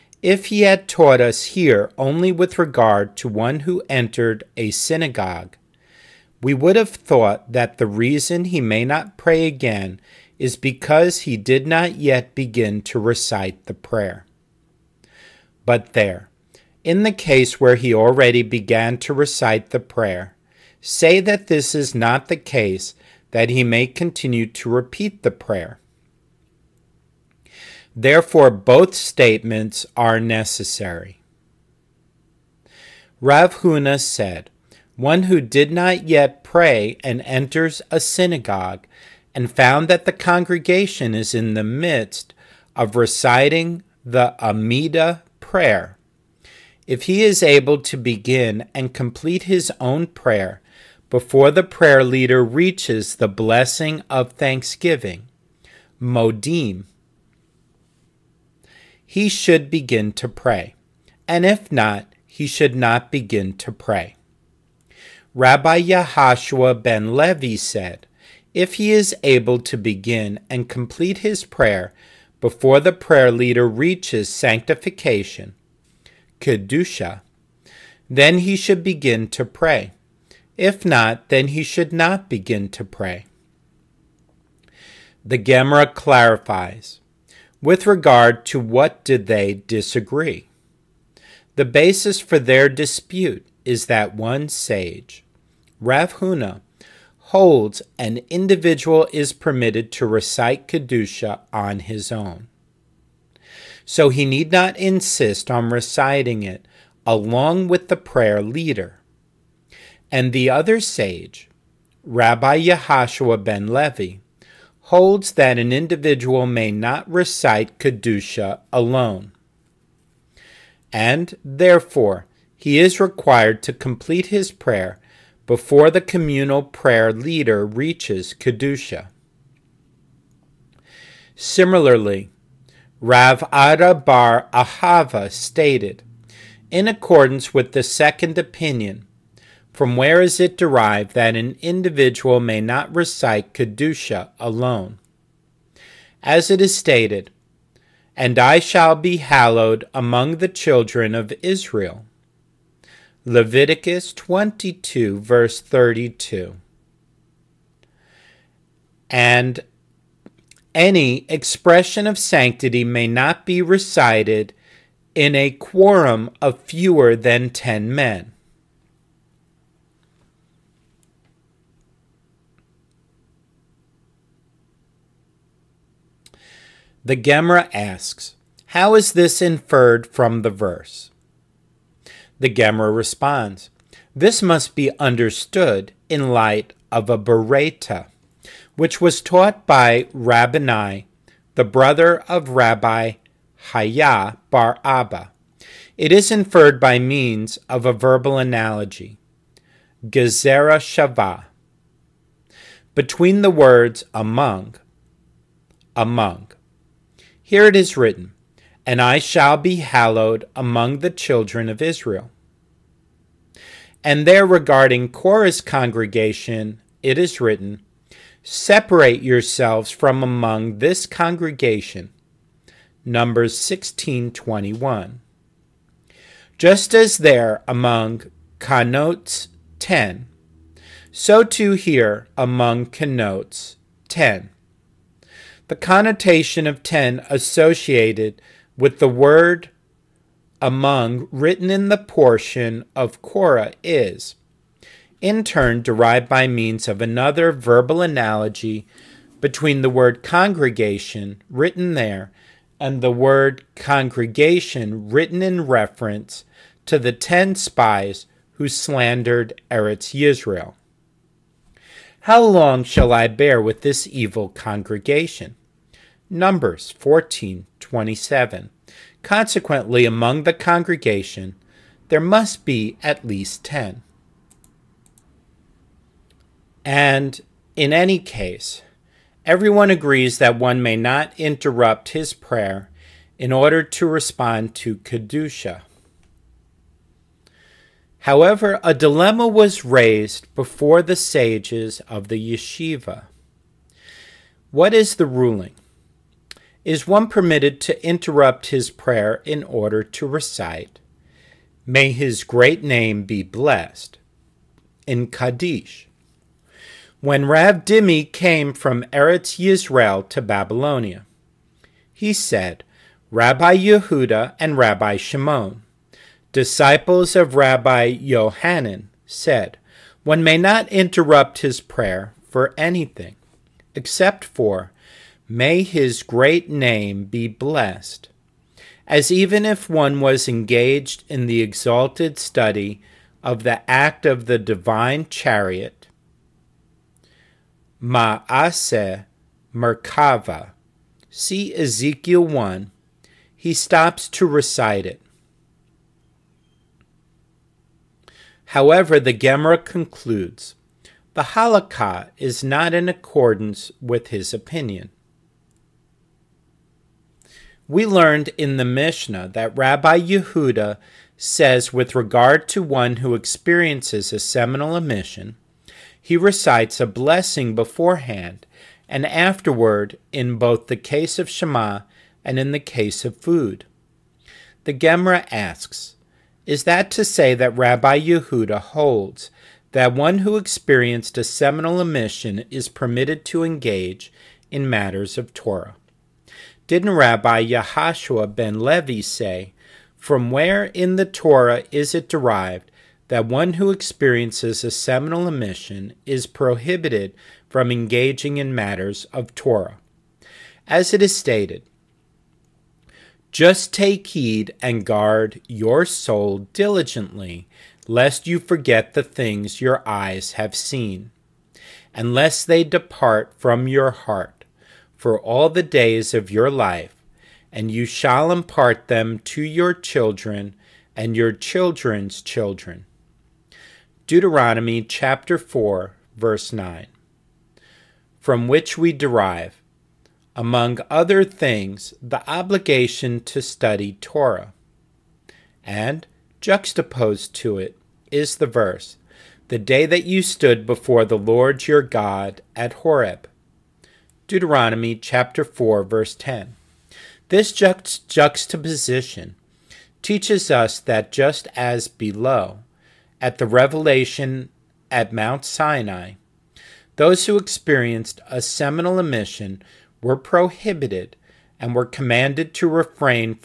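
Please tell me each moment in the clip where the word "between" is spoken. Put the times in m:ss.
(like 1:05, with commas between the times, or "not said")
3:22, 4:09.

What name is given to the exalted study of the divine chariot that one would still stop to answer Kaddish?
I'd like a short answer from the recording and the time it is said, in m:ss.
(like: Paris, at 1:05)
Maase Merkava, at 5:38.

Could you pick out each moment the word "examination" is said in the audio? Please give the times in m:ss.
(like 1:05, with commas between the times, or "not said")
not said.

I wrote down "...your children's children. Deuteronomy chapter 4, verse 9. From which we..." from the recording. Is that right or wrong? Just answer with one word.
right.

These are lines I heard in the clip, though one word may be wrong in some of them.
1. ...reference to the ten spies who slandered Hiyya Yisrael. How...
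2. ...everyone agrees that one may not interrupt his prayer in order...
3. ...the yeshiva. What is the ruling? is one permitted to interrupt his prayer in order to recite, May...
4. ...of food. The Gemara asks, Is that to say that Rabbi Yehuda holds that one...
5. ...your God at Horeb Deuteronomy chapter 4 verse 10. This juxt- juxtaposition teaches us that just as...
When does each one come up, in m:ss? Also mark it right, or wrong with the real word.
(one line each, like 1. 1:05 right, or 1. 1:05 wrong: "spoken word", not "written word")
1. 4:15 wrong: "Eretz", not "Hiyya"
2. 4:39 right
3. 4:52 right
4. 6:13 right
5. 7:21 right.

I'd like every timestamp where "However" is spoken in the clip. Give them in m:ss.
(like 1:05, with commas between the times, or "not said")
4:48, 5:48.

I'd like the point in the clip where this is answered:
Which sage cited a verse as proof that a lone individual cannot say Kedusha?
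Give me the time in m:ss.
2:13.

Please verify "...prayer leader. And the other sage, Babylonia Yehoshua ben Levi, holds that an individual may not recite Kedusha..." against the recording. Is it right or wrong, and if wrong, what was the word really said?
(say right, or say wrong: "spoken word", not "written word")
wrong: "Rabbi", not "Babylonia".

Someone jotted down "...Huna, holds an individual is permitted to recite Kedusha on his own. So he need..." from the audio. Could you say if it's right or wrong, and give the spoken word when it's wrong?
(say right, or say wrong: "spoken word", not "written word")
right.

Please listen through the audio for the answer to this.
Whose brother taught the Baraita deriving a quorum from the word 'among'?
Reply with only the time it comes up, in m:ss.
3:12.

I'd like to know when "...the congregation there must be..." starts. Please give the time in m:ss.
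4:30.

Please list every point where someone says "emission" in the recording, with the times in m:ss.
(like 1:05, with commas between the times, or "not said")
6:04, 6:22, 6:35, 7:39.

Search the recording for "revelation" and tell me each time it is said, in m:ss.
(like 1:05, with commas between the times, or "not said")
7:33.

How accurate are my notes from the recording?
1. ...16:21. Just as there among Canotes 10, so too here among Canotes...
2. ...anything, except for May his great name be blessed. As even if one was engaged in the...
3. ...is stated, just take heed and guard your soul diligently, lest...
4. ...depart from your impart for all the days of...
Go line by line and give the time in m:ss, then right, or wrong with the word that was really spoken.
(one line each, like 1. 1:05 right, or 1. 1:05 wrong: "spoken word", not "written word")
1. 3:43 right
2. 5:22 right
3. 6:41 right
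4. 6:52 wrong: "heart", not "impart".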